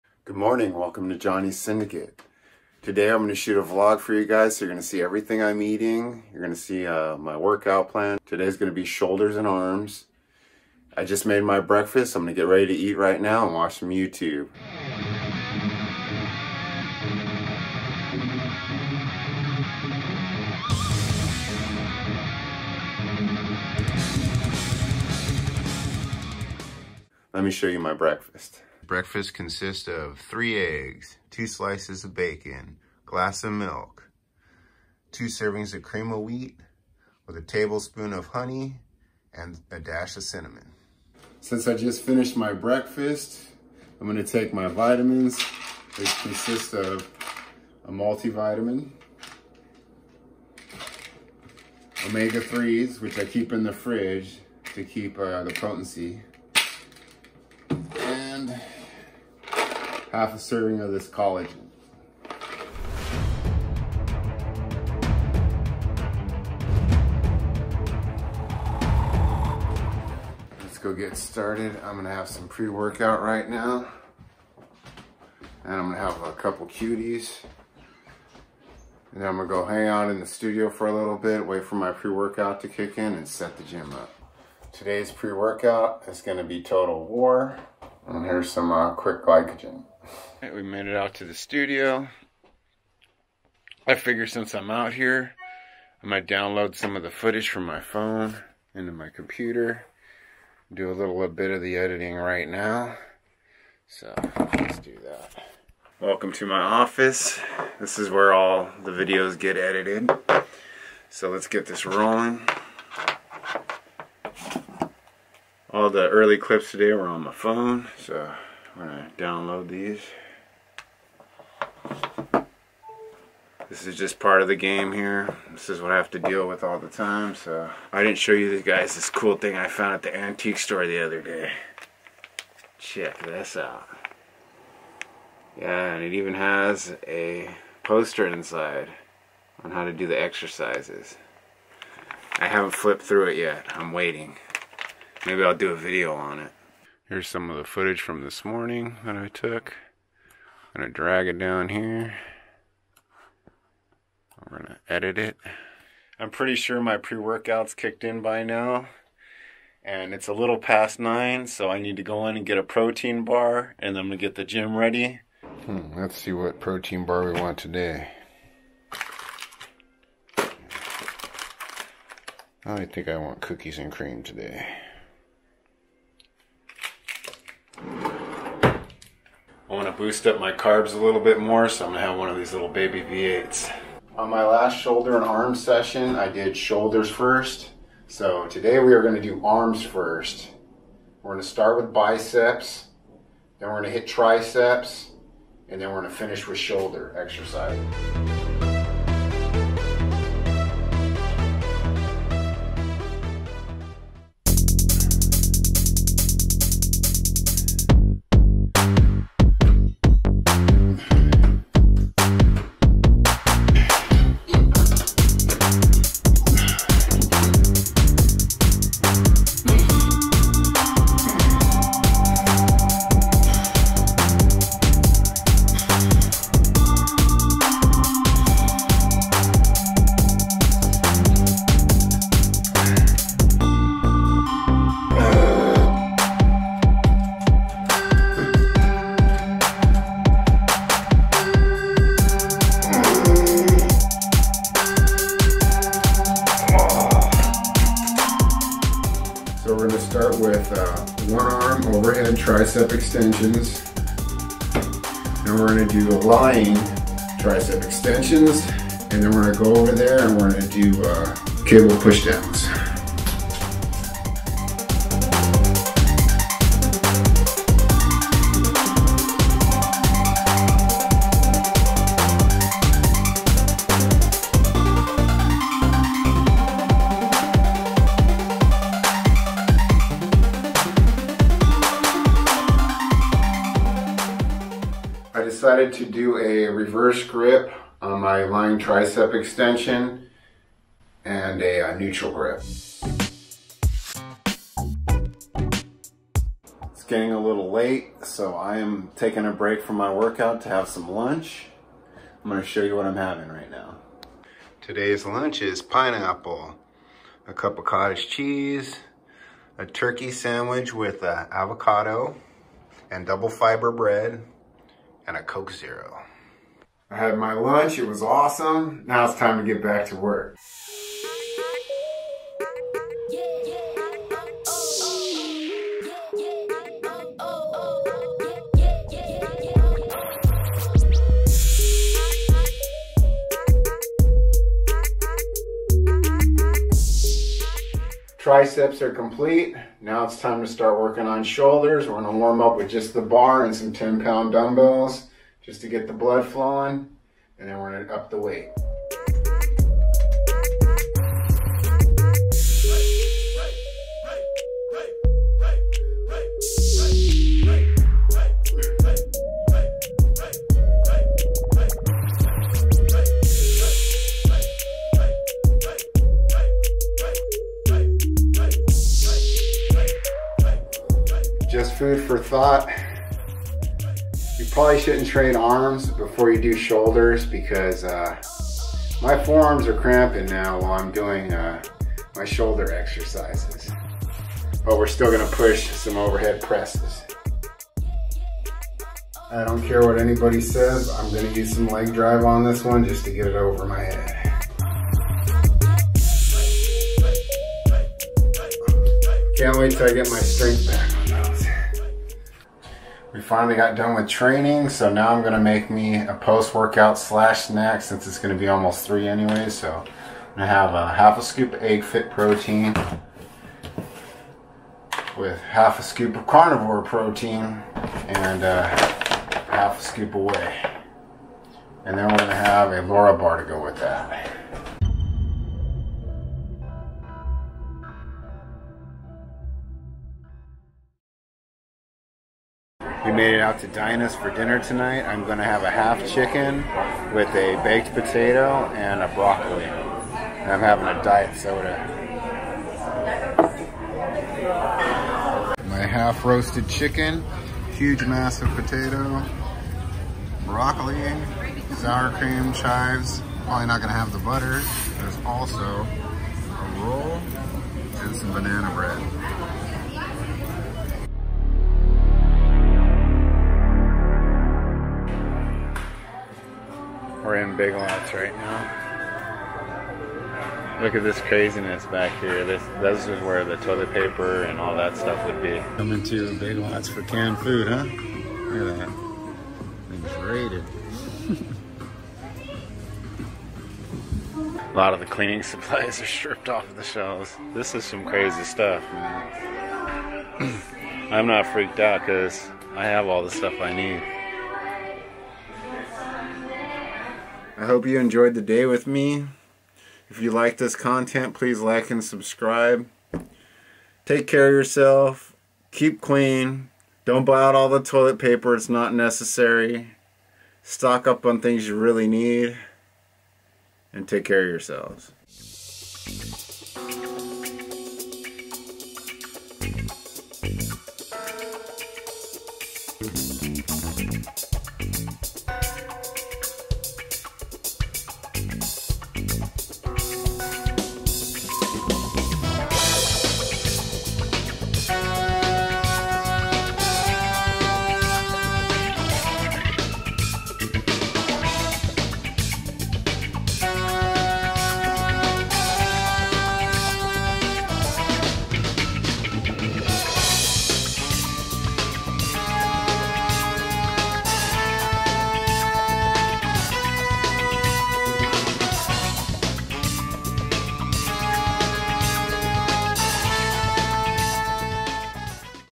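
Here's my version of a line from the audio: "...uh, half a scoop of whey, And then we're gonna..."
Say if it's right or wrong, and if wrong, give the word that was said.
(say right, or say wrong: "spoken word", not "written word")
right.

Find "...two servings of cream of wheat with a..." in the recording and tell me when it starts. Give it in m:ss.
0:35.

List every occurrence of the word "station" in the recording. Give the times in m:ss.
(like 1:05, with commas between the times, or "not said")
not said.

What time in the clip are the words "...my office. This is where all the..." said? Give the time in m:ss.
1:46.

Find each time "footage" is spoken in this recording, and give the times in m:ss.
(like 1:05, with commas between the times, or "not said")
1:37, 2:27.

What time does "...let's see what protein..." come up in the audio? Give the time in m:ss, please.
2:45.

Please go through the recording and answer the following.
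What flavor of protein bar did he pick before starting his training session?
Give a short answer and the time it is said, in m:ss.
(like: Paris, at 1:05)
cookies and cream, at 2:53.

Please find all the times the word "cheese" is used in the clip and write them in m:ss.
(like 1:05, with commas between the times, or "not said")
5:08.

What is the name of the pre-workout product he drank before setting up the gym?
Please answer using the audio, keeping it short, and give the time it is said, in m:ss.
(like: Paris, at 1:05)
Total War, at 1:26.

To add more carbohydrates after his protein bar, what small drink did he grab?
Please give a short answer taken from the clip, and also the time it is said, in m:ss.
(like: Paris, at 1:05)
V8, at 3:03.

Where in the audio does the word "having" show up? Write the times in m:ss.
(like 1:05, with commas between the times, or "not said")
5:03, 7:20.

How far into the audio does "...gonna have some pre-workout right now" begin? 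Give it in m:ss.
1:11.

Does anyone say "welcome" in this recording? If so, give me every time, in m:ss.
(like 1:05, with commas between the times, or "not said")
0:00, 1:45.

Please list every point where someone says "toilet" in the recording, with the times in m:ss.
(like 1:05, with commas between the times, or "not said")
7:53, 8:27.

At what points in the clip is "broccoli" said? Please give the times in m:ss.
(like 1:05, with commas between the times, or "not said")
7:19, 7:30.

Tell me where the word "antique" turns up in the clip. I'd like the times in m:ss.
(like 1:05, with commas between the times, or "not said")
2:10.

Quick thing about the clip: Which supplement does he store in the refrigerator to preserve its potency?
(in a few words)
omega-3s.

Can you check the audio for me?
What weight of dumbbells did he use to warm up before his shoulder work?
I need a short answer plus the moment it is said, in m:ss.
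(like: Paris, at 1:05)
10 pounds, at 5:43.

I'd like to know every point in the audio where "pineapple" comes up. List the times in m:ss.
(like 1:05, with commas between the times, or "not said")
5:05.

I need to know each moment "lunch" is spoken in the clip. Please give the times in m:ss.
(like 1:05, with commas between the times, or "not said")
5:01, 5:05, 5:17.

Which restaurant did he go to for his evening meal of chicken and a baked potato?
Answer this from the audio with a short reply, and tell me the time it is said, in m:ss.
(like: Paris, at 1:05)
Dinah's, at 7:13.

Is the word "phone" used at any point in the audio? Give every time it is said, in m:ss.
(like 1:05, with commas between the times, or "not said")
1:37, 1:57.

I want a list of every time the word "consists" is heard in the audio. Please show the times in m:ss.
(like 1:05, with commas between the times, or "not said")
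0:29, 0:46.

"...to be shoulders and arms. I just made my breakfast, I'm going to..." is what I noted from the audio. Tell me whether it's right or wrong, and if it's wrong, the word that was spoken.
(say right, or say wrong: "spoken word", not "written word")
right.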